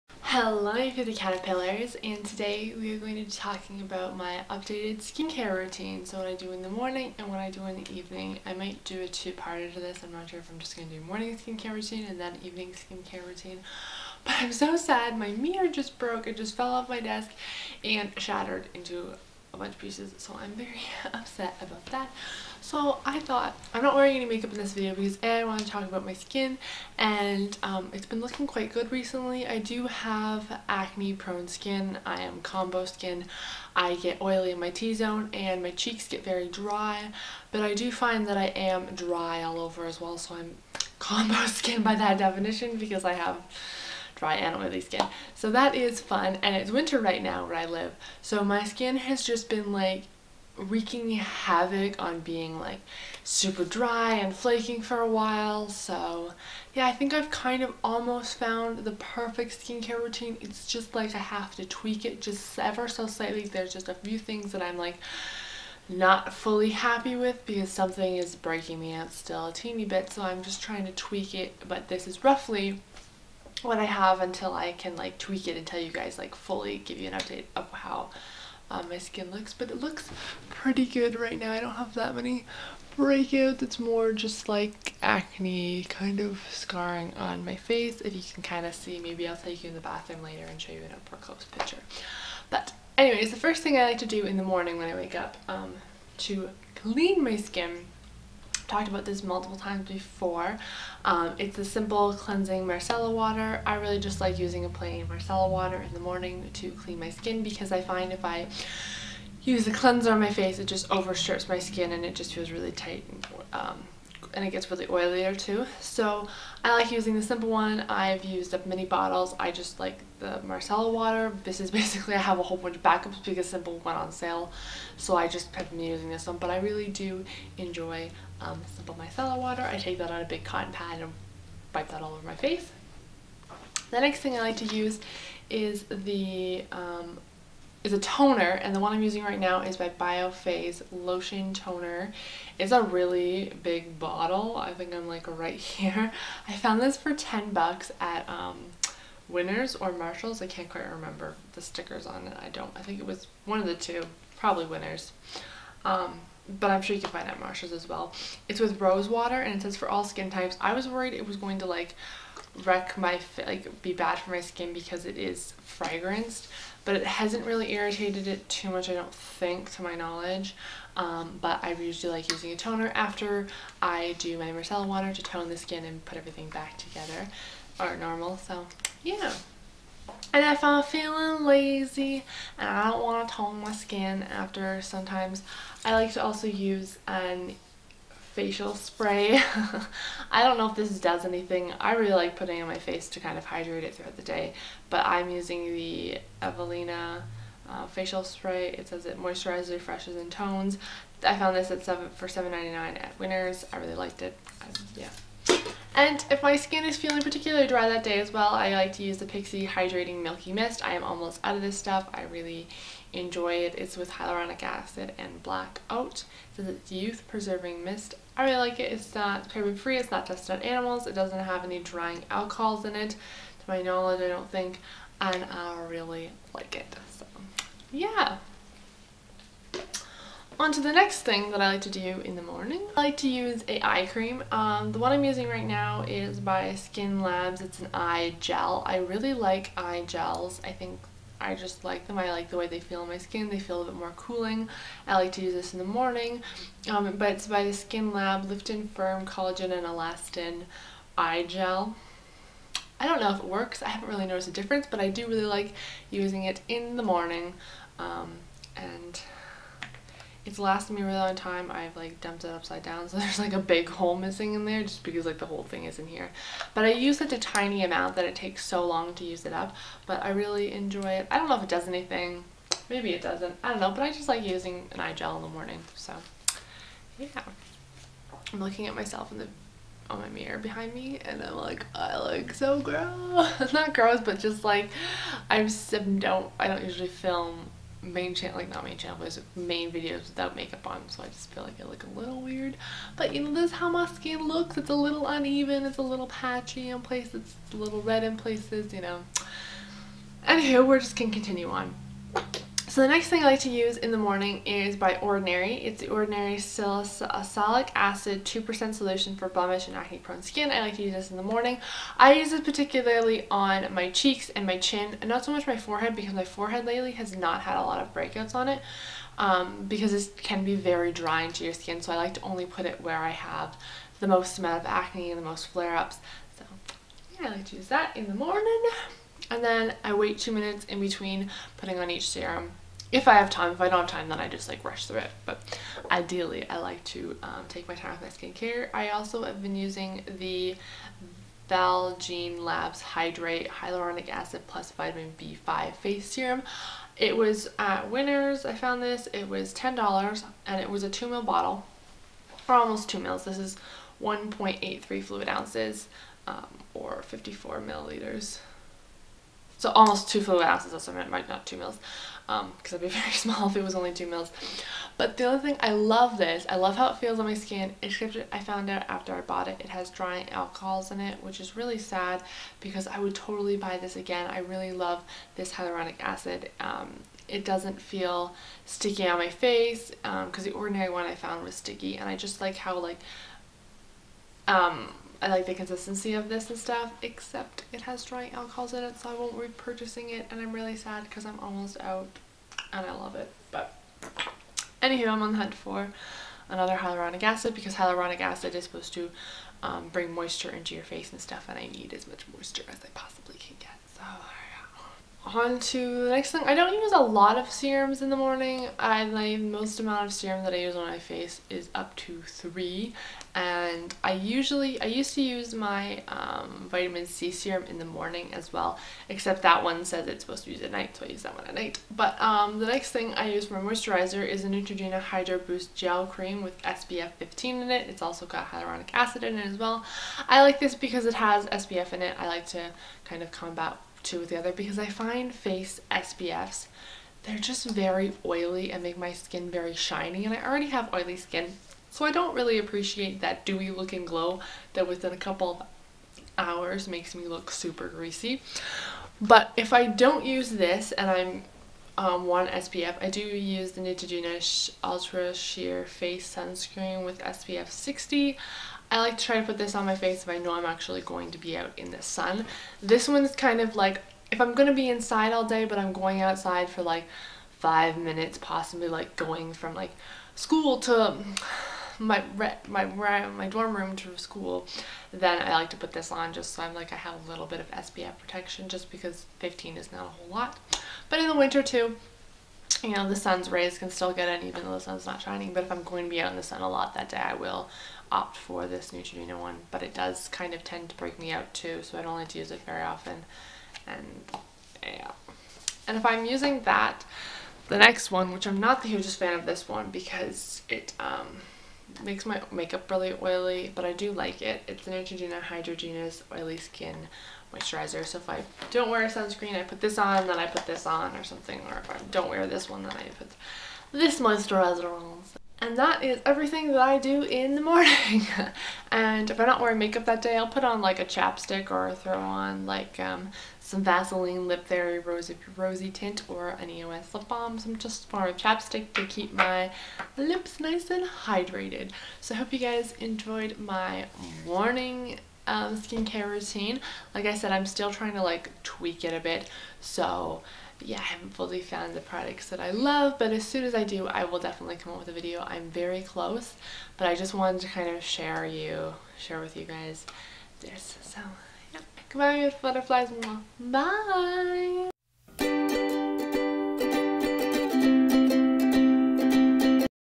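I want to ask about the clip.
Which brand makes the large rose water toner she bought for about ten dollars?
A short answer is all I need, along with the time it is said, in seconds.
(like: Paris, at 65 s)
Biophase, at 139 s.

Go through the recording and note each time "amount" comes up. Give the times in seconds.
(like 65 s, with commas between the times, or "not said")
267 s, 324 s, 409 s.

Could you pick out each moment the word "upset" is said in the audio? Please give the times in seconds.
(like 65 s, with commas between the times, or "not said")
21 s.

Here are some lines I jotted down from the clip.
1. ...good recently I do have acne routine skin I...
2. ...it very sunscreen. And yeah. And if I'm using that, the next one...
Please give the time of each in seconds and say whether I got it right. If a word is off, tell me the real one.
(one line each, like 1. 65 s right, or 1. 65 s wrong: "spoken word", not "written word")
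1. 28 s wrong: "prone", not "routine"
2. 492 s wrong: "often", not "sunscreen".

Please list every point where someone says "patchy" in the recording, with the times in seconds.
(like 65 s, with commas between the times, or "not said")
296 s.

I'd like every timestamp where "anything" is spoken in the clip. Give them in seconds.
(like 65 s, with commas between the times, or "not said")
191 s, 271 s.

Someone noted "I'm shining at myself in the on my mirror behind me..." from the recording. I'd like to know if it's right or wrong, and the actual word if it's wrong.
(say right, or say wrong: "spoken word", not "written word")
wrong: "looking", not "shining".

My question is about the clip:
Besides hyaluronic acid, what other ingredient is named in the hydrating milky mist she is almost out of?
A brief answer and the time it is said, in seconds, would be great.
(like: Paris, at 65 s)
black oat, at 215 s.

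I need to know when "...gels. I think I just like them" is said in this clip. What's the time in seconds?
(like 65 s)
240 s.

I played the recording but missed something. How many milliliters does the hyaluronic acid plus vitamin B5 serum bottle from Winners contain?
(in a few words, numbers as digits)
54.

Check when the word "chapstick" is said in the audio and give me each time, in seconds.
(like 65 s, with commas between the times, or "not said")
521 s, 528 s.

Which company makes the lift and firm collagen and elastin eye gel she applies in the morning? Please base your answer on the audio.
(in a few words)
Skin Labs.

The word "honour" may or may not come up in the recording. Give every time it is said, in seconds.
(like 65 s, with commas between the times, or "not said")
not said.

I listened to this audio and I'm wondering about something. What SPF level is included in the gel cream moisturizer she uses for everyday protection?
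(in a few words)
15.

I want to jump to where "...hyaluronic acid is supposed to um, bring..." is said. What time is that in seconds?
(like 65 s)
397 s.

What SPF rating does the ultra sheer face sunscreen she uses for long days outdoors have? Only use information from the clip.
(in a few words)
60.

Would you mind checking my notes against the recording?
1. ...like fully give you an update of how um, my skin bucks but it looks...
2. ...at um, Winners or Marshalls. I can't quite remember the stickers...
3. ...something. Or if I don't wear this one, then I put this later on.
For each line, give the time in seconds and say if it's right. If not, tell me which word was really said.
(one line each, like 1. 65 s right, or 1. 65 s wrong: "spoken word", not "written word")
1. 76 s wrong: "looks", not "bucks"
2. 147 s right
3. 511 s wrong: "moisturizer", not "later".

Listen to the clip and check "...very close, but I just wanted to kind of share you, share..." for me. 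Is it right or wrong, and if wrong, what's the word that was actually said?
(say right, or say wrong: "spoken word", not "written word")
right.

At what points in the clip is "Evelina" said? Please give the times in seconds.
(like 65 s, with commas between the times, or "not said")
196 s.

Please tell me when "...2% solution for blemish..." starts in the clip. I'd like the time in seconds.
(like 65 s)
308 s.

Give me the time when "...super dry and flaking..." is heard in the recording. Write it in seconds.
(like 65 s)
53 s.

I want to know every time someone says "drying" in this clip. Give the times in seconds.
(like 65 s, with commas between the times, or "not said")
221 s, 321 s, 370 s, 388 s.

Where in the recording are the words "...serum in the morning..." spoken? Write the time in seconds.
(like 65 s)
417 s.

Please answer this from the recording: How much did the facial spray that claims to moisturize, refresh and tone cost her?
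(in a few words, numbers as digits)
$7.99.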